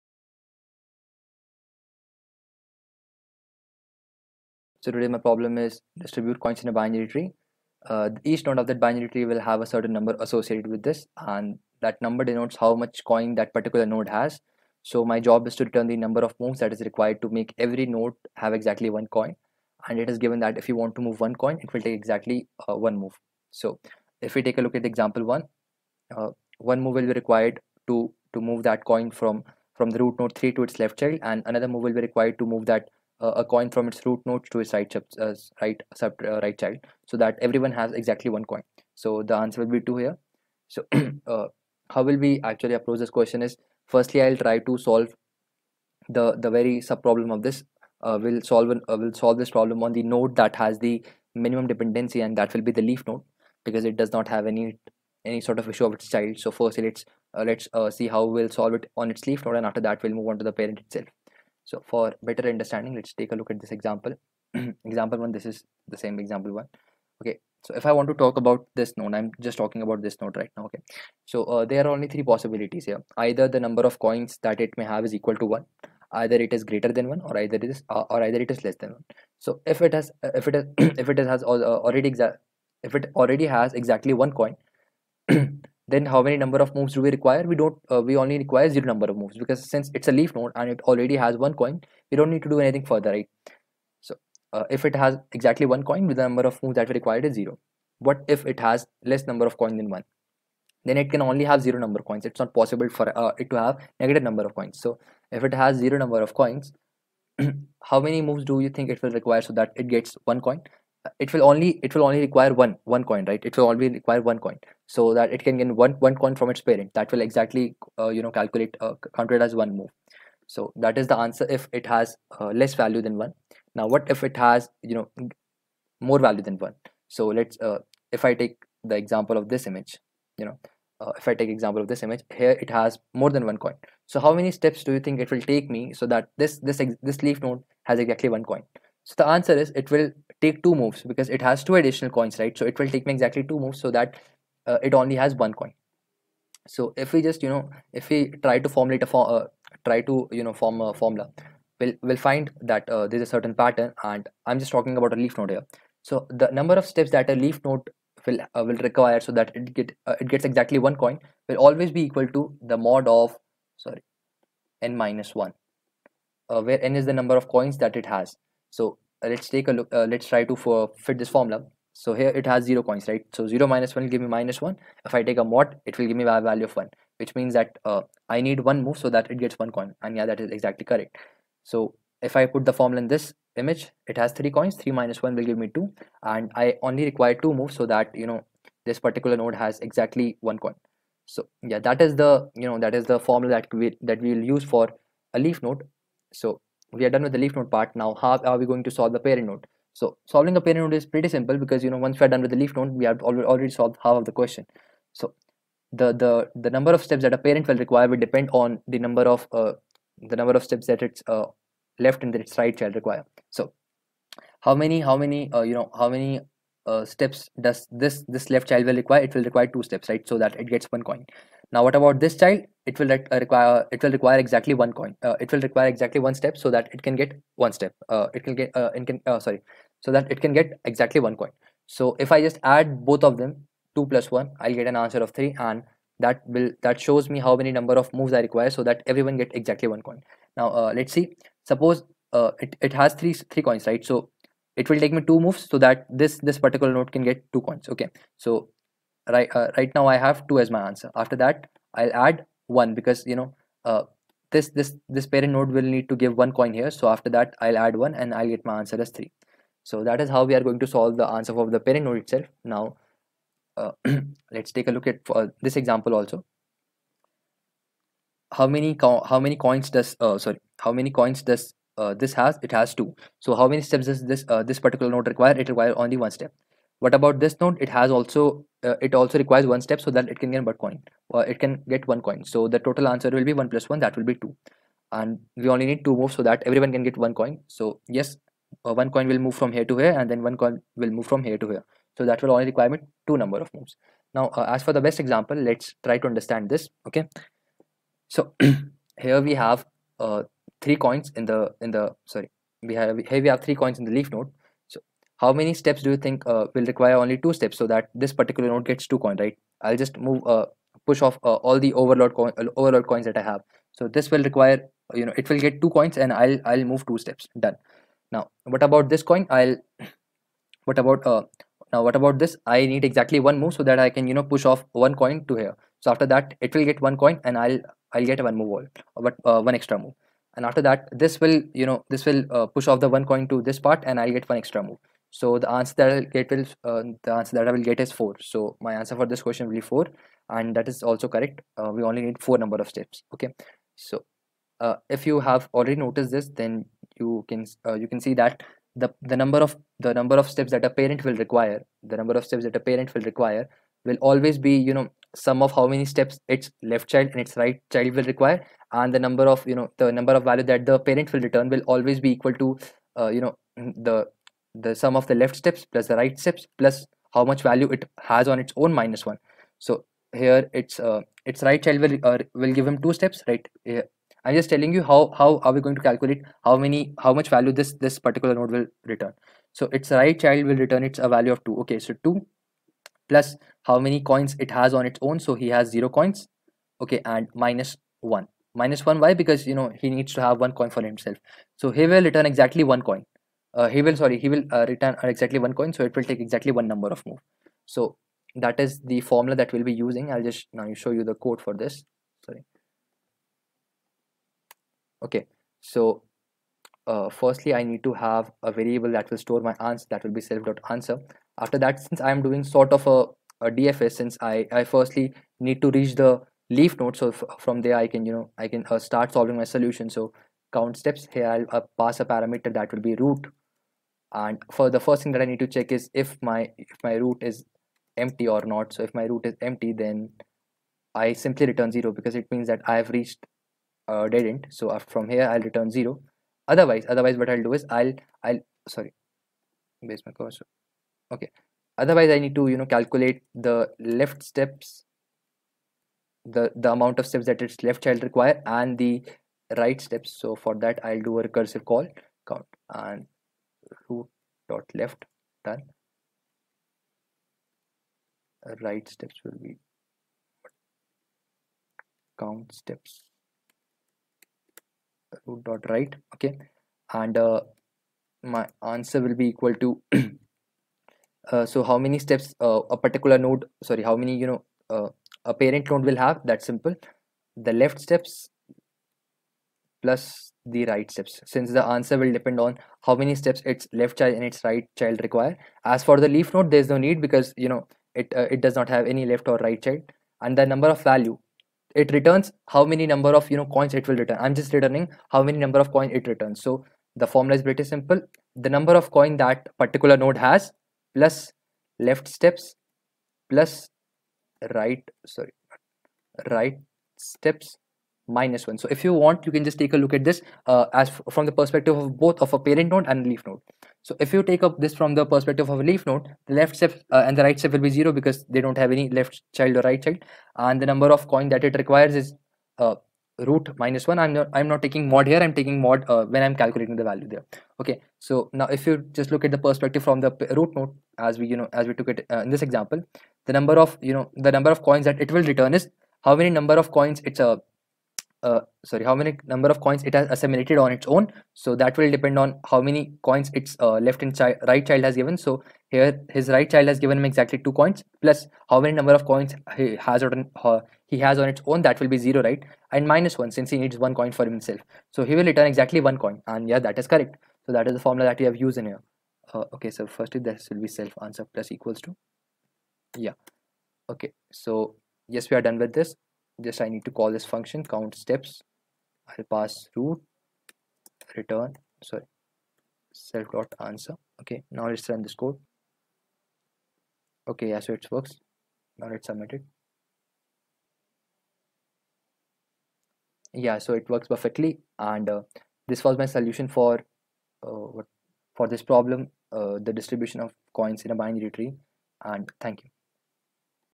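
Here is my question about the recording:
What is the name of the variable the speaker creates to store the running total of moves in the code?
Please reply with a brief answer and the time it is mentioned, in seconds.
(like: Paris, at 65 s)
self.answer, at 410 s.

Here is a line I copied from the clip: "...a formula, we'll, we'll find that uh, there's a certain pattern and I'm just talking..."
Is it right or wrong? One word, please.
right.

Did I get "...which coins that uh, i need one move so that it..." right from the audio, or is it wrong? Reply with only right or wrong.
wrong.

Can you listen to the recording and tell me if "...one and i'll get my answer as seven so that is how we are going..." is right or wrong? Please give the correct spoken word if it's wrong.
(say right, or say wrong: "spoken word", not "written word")
wrong: "three", not "seven".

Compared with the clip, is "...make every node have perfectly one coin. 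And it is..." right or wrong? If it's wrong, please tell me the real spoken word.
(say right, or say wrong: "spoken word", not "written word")
wrong: "exactly", not "perfectly".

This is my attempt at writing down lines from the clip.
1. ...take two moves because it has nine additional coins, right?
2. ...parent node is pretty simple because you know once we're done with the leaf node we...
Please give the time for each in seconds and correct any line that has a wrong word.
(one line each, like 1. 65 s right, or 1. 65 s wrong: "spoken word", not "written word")
1. 140 s wrong: "two", not "nine"
2. 200 s right.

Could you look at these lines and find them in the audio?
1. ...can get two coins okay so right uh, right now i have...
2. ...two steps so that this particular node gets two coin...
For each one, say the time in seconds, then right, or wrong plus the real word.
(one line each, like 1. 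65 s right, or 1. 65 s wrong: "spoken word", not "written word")
1. 247 s right
2. 307 s right.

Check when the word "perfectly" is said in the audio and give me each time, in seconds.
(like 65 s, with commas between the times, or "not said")
584 s.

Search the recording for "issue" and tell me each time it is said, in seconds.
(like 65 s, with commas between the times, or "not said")
55 s.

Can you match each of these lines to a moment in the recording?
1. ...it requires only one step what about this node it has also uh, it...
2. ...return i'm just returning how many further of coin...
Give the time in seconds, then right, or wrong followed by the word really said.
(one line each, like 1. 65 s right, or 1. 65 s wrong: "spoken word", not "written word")
1. 275 s right
2. 494 s wrong: "number", not "further".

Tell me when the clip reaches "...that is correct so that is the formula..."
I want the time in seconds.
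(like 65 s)
556 s.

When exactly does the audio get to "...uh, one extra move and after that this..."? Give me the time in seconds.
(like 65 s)
329 s.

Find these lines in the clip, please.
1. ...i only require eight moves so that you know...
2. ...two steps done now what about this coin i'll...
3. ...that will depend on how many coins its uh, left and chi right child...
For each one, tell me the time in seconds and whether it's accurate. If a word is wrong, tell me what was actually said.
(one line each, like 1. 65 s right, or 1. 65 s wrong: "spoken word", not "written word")
1. 186 s wrong: "two", not "eight"
2. 317 s right
3. 541 s right.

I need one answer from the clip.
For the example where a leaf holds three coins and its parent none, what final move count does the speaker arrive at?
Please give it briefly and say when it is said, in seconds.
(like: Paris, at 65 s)
4, at 337 s.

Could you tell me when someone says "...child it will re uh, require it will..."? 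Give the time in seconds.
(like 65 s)
222 s.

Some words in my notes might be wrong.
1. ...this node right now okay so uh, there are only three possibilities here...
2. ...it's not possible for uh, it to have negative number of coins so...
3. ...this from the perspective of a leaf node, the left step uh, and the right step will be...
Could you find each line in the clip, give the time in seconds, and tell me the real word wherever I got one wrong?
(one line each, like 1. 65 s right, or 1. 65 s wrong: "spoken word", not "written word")
1. 70 s right
2. 102 s right
3. 514 s right.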